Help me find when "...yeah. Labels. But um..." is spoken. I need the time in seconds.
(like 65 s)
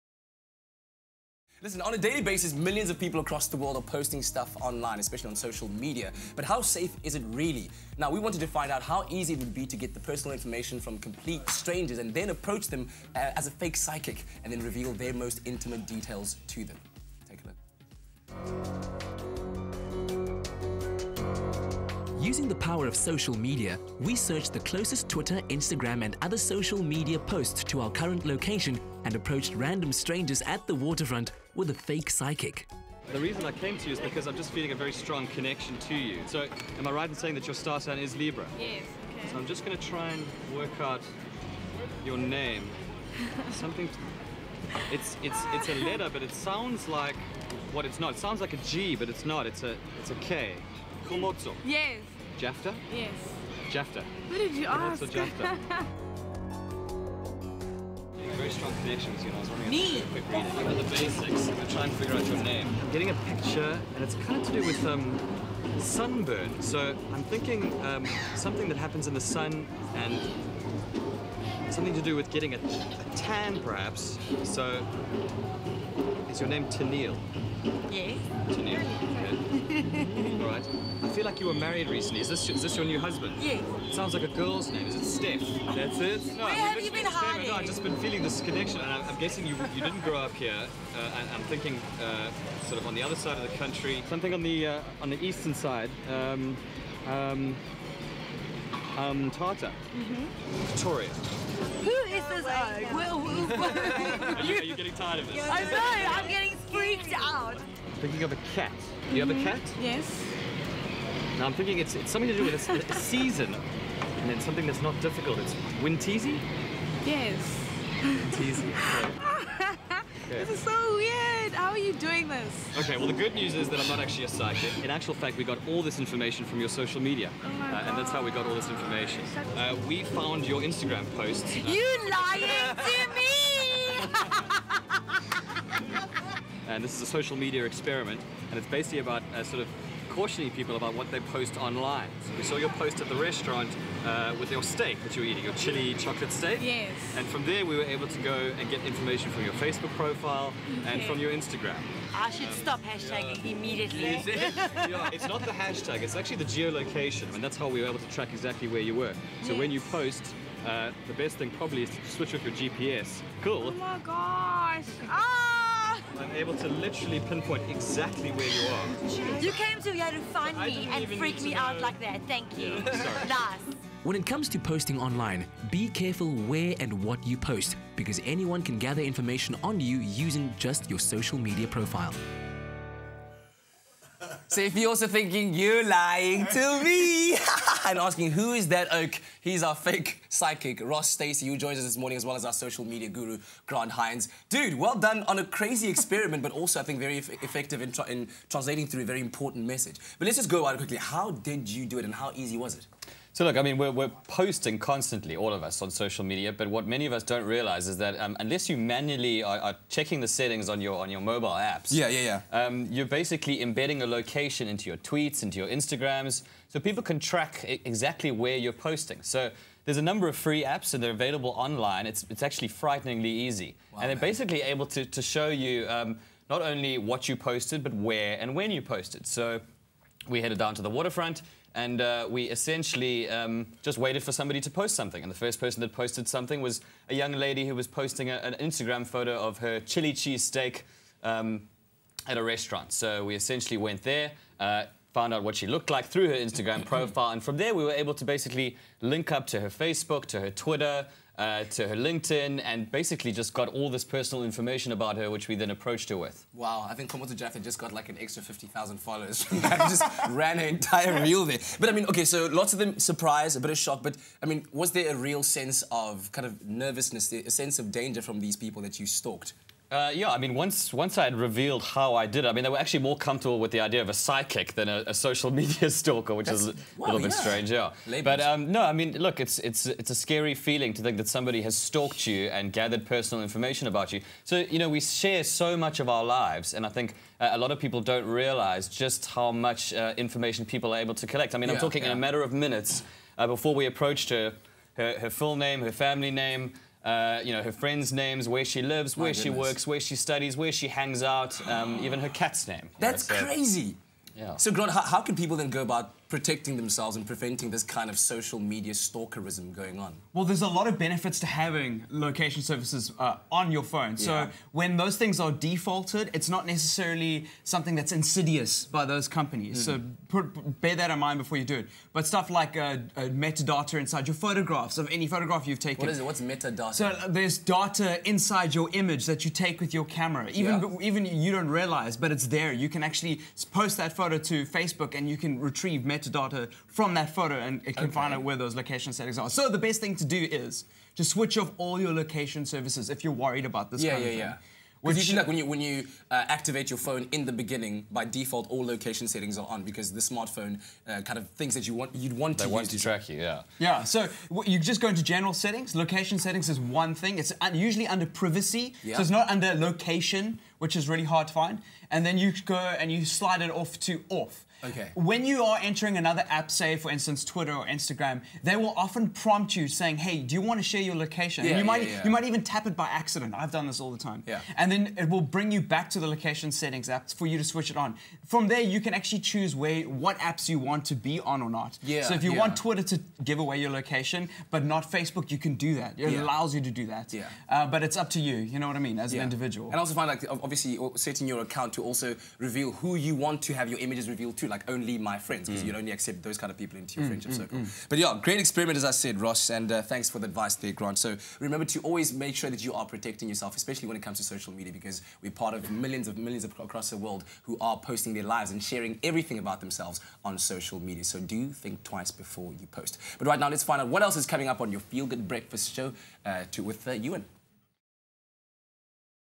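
277 s.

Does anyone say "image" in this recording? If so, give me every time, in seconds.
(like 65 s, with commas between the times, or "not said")
328 s, 393 s.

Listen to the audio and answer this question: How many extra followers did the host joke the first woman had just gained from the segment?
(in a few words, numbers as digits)
50,000.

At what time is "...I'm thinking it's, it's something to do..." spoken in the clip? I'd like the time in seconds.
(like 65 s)
111 s.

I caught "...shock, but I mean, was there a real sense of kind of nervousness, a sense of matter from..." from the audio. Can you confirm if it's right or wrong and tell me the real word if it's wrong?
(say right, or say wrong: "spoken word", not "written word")
wrong: "danger", not "matter".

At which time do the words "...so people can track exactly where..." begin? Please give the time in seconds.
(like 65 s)
216 s.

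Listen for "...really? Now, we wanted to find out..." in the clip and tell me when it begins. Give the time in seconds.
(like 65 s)
7 s.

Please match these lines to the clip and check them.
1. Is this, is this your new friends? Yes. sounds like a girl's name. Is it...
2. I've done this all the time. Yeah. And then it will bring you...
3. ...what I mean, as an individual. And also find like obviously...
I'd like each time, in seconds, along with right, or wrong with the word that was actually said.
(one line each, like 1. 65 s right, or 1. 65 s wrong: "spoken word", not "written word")
1. 82 s wrong: "husband", not "friends"
2. 373 s right
3. 388 s right.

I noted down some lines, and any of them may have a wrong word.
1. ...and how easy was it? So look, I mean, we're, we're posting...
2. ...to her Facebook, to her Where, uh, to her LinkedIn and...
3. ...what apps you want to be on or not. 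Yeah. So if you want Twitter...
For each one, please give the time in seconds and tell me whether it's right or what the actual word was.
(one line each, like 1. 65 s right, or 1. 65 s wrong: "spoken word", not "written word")
1. 202 s right
2. 249 s wrong: "Twitter", not "Where"
3. 380 s right.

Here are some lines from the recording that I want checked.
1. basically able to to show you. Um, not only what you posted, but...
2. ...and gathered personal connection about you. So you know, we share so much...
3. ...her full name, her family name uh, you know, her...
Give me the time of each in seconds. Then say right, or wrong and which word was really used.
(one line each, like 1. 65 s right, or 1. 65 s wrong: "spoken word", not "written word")
1. 224 s right
2. 282 s wrong: "information", not "connection"
3. 295 s right.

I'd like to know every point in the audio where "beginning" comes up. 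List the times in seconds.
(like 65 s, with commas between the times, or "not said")
347 s.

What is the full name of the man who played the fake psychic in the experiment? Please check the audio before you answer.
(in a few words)
Ross Stacey.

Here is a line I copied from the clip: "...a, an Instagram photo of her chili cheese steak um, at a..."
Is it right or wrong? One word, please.
right.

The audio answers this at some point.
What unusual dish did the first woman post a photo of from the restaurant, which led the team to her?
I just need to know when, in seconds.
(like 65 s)
145 s.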